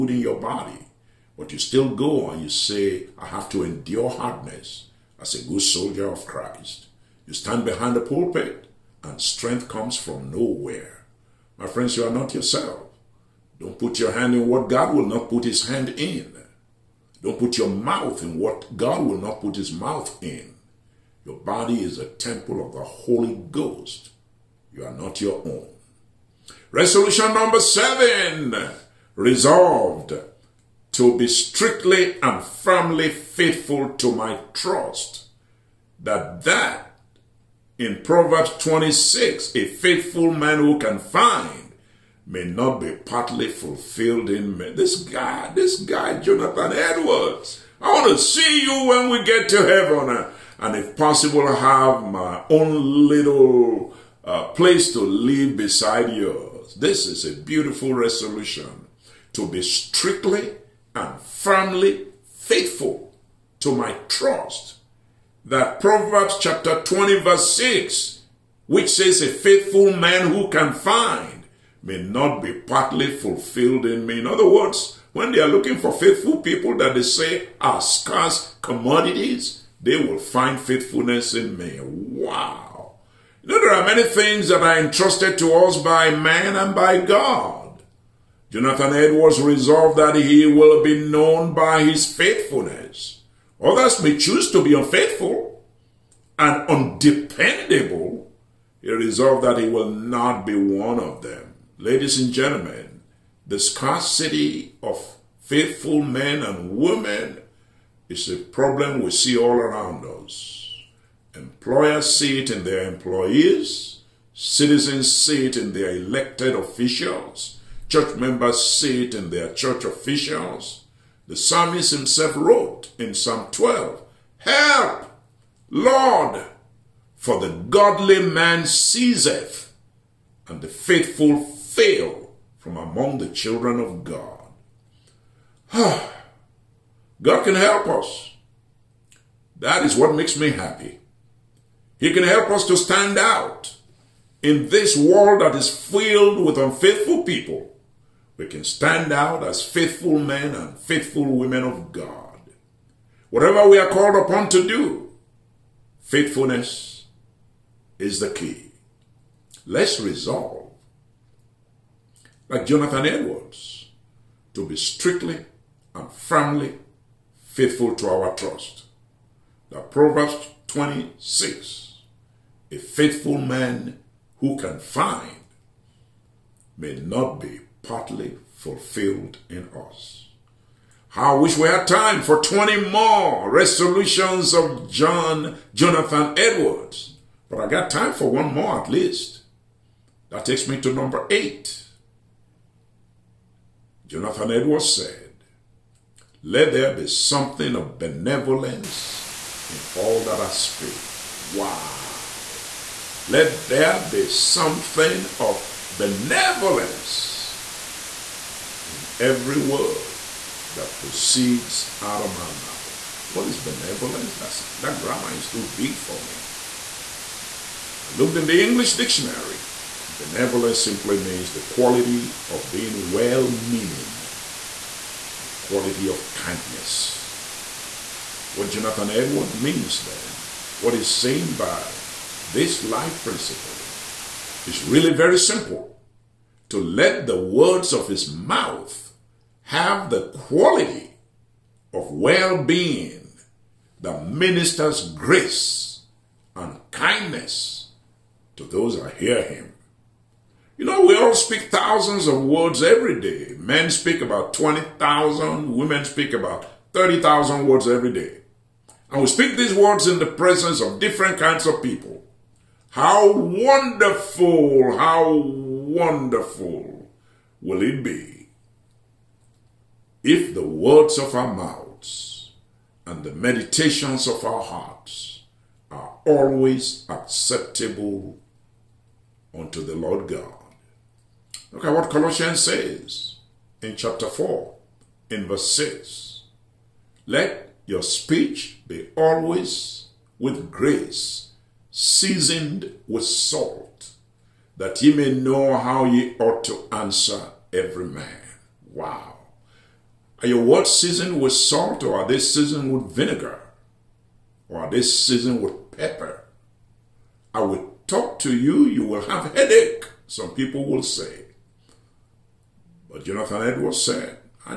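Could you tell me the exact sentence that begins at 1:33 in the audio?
Others may choose to be unfaithful and undependable.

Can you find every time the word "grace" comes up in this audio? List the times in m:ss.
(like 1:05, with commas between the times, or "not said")
4:05, 4:50.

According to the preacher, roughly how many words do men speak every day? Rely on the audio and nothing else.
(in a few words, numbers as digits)
20,000.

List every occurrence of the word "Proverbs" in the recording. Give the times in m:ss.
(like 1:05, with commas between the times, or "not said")
0:38, 1:05, 2:49.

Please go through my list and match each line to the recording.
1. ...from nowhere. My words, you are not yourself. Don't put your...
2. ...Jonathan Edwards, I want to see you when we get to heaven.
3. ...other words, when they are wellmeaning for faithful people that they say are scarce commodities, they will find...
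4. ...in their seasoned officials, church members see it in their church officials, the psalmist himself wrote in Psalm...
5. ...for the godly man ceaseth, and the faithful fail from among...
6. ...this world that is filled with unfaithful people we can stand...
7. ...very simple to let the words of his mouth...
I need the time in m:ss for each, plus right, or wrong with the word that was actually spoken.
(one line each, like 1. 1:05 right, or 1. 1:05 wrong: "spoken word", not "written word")
1. 0:09 wrong: "friends", not "words"
2. 0:46 right
3. 1:14 wrong: "looking", not "wellmeaning"
4. 1:55 wrong: "elected", not "seasoned"
5. 2:07 right
6. 2:24 right
7. 3:55 right.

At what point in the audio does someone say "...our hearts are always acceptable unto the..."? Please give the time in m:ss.
4:34.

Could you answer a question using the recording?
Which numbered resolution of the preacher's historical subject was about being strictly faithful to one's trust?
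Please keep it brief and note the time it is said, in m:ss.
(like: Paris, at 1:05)
7, at 0:27.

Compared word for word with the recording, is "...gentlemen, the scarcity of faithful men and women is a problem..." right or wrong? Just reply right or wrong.
right.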